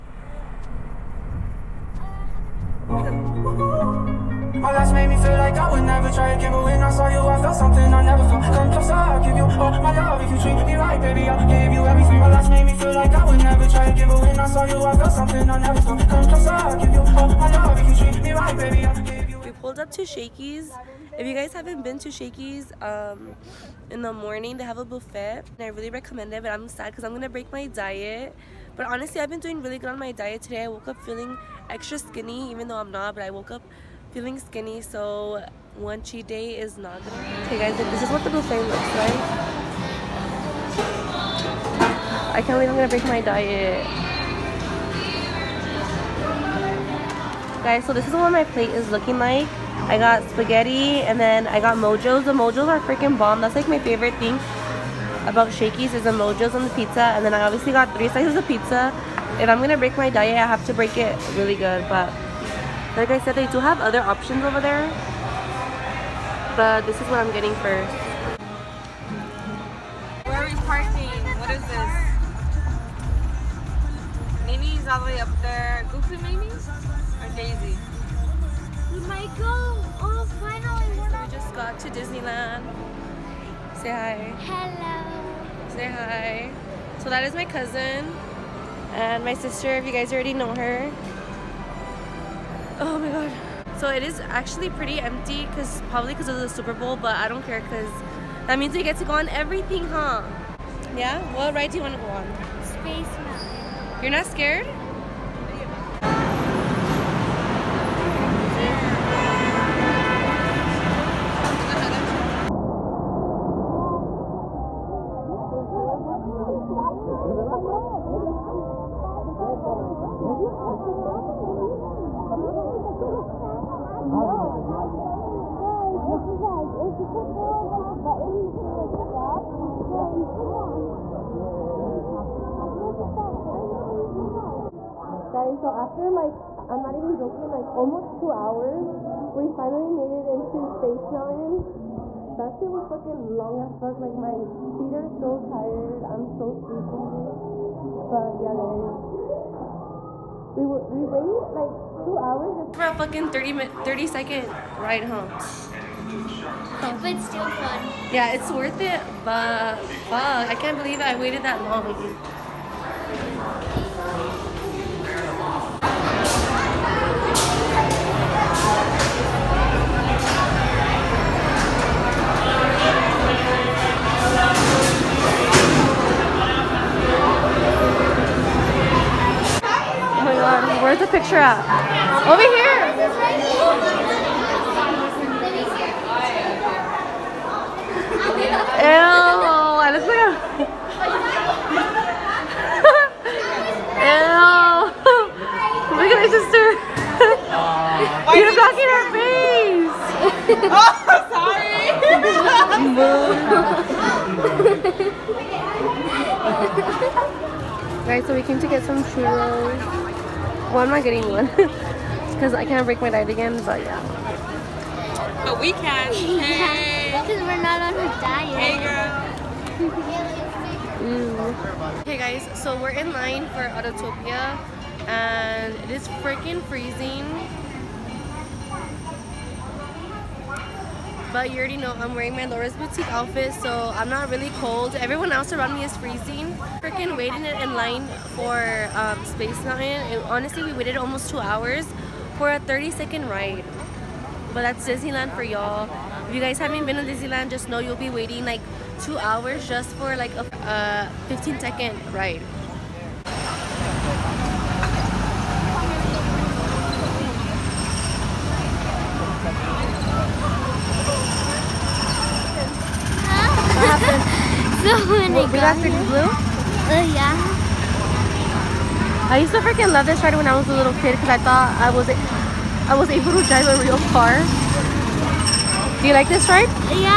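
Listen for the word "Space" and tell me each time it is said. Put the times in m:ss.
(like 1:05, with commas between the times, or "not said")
1:42, 2:20, 3:59.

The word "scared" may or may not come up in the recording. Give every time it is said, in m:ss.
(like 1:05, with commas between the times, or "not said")
1:44.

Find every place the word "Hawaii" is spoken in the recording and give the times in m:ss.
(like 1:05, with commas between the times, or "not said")
2:15.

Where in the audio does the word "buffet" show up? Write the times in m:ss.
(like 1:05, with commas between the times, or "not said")
0:24, 0:38.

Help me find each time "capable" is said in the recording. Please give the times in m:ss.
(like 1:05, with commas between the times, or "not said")
not said.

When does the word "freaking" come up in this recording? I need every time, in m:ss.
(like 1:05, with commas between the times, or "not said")
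0:52, 3:46, 3:56, 4:29.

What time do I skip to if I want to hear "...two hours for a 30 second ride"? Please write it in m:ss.
4:01.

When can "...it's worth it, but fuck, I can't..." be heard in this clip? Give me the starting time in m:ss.
2:38.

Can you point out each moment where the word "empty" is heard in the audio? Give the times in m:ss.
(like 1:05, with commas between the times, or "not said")
1:34.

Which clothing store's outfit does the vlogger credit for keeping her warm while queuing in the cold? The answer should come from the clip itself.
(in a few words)
Laura's Boutique.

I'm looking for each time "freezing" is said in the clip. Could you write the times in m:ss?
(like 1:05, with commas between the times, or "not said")
3:46, 3:55.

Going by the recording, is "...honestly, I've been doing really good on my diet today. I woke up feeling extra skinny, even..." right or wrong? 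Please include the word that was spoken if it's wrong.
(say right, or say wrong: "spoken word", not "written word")
right.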